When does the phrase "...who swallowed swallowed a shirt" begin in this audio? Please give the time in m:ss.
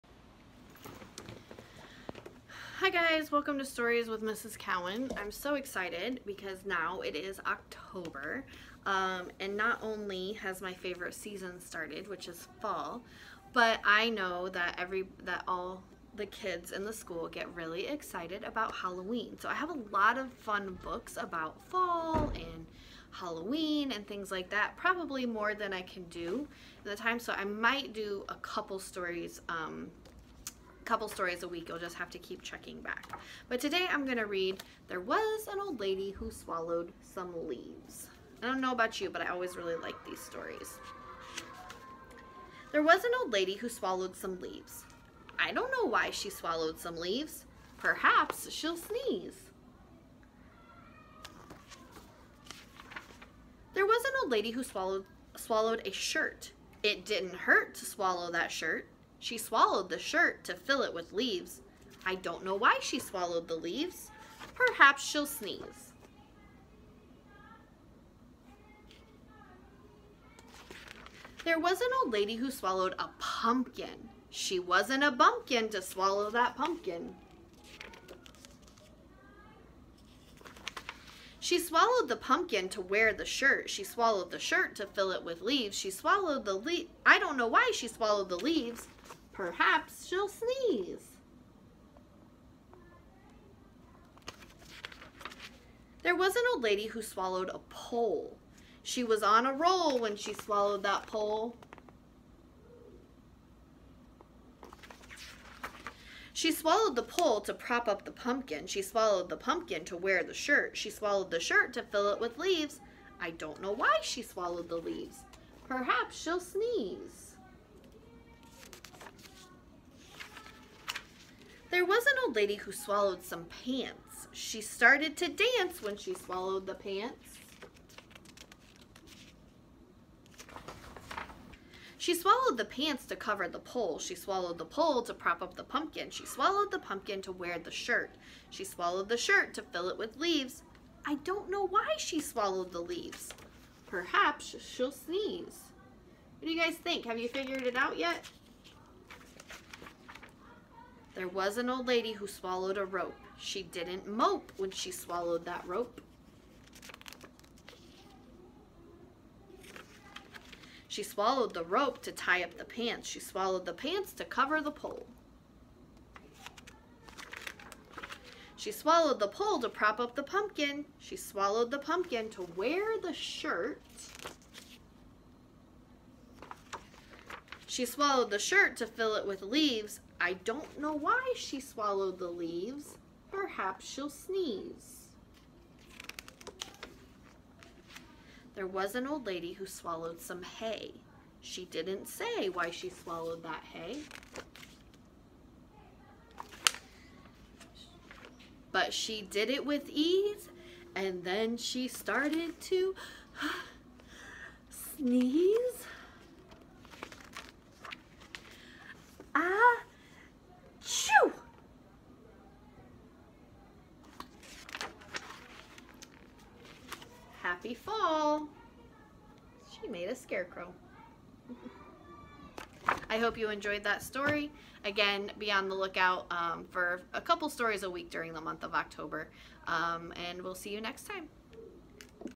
0:54.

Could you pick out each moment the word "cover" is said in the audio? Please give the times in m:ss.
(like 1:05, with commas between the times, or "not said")
2:13, 2:44.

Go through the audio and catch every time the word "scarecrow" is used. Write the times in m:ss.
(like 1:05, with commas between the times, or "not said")
3:40.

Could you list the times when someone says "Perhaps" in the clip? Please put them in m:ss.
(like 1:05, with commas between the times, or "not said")
0:47, 1:04, 1:29, 1:55, 2:23, 3:03.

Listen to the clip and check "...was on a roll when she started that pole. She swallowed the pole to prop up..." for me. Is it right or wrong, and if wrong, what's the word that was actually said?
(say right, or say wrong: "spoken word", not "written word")
wrong: "swallowed", not "started".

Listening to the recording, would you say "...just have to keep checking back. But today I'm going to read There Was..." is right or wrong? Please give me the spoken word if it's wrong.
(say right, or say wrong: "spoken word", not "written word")
right.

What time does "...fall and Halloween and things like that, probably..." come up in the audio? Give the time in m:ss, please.
0:21.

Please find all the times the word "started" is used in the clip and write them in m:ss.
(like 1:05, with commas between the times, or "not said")
0:11, 2:04, 3:21.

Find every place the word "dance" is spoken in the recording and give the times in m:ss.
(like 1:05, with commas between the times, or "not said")
2:05.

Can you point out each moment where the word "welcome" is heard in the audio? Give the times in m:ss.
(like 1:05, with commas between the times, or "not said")
0:03.